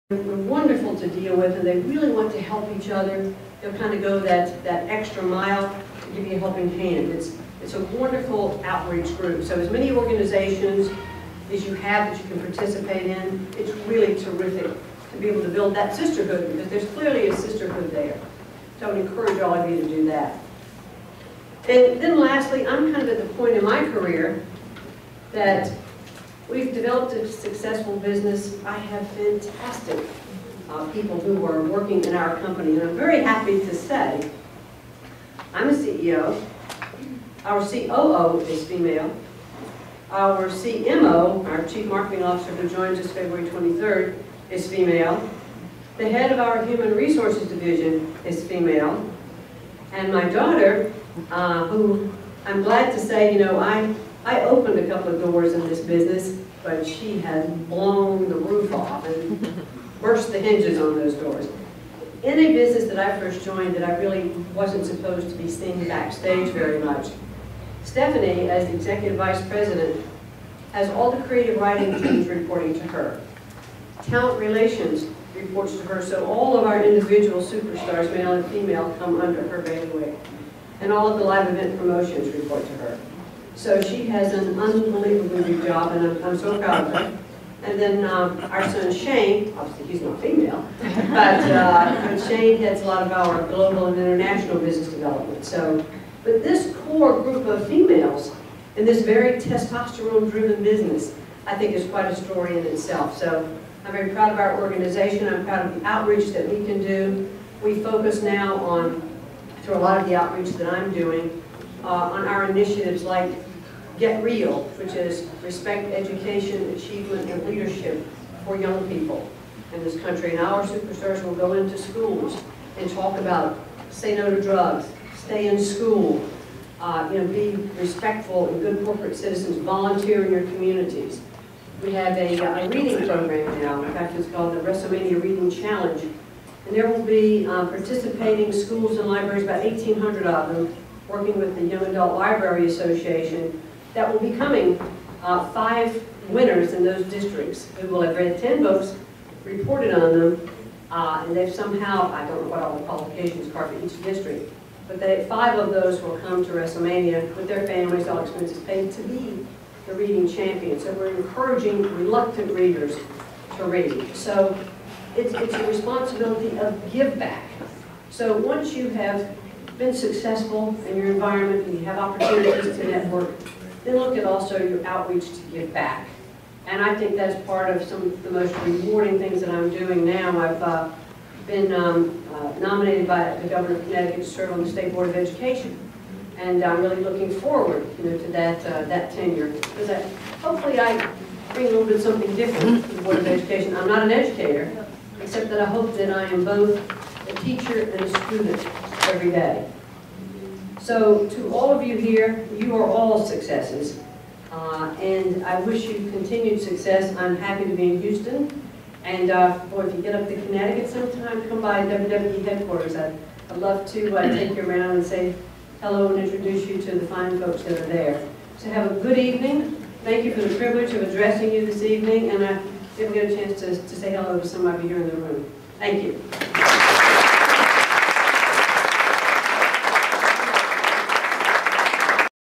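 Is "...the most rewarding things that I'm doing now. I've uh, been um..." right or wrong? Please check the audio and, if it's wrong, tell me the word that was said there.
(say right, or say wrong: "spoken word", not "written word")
right.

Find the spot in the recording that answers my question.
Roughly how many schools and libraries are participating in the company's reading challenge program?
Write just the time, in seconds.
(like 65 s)
139 s.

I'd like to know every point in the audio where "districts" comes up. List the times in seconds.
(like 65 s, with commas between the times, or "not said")
147 s, 154 s.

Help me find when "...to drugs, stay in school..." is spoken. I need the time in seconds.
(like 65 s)
124 s.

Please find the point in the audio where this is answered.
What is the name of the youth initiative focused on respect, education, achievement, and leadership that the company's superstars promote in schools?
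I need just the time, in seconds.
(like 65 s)
114 s.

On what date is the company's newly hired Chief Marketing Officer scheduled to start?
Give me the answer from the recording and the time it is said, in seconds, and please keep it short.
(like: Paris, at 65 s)
February 23rd, at 43 s.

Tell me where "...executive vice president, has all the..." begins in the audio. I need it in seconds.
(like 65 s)
68 s.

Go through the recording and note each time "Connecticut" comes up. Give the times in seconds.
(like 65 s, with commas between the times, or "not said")
183 s, 210 s.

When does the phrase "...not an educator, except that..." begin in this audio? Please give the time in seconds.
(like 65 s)
193 s.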